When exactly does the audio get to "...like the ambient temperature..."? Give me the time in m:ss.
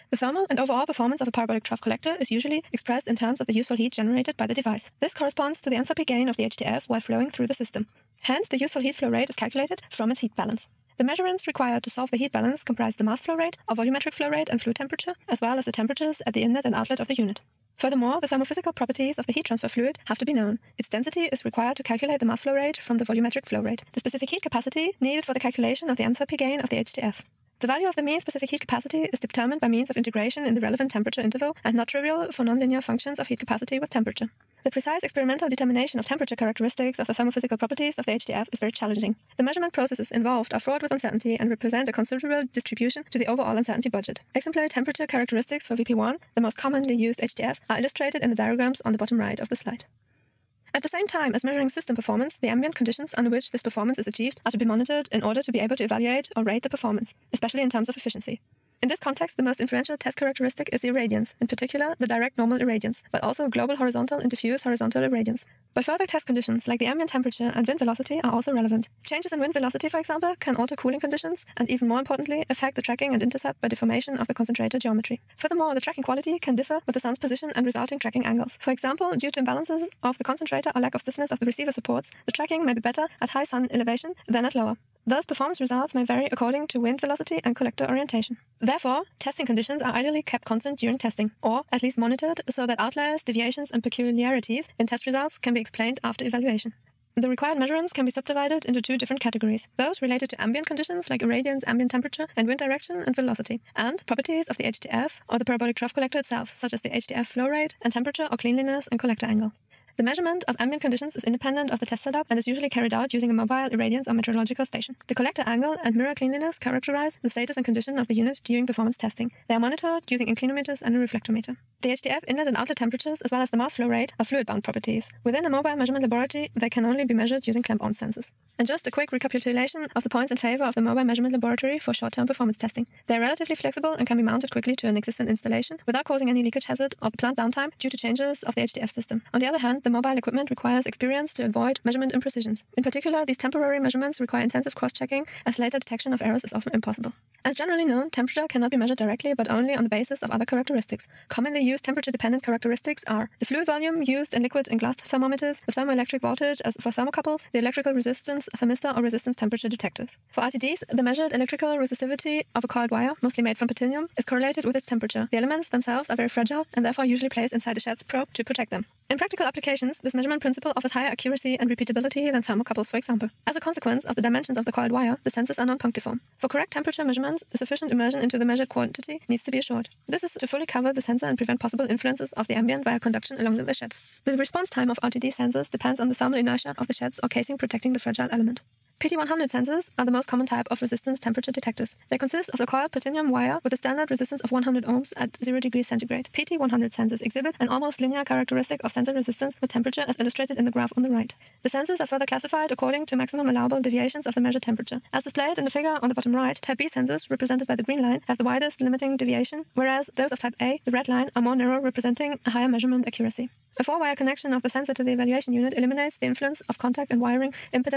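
1:06.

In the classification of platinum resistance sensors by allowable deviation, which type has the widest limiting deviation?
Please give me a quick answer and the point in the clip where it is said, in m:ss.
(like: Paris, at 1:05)
type B, at 3:26.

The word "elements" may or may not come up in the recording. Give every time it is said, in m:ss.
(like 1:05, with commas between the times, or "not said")
2:45, 3:08.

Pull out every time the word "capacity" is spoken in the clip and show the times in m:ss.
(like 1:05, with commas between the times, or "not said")
0:24, 0:28, 0:33.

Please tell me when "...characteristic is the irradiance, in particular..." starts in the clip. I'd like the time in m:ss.
1:00.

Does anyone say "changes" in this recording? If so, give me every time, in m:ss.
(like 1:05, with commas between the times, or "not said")
1:09, 2:17.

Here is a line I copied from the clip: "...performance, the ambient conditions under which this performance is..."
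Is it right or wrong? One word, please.
right.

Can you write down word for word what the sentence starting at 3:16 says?
PT100 sensors exhibit an almost linear characteristic of sensor resistance with temperature as illustrated in the graph on the right.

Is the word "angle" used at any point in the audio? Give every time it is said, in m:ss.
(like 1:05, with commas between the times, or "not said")
1:18, 1:49, 1:55.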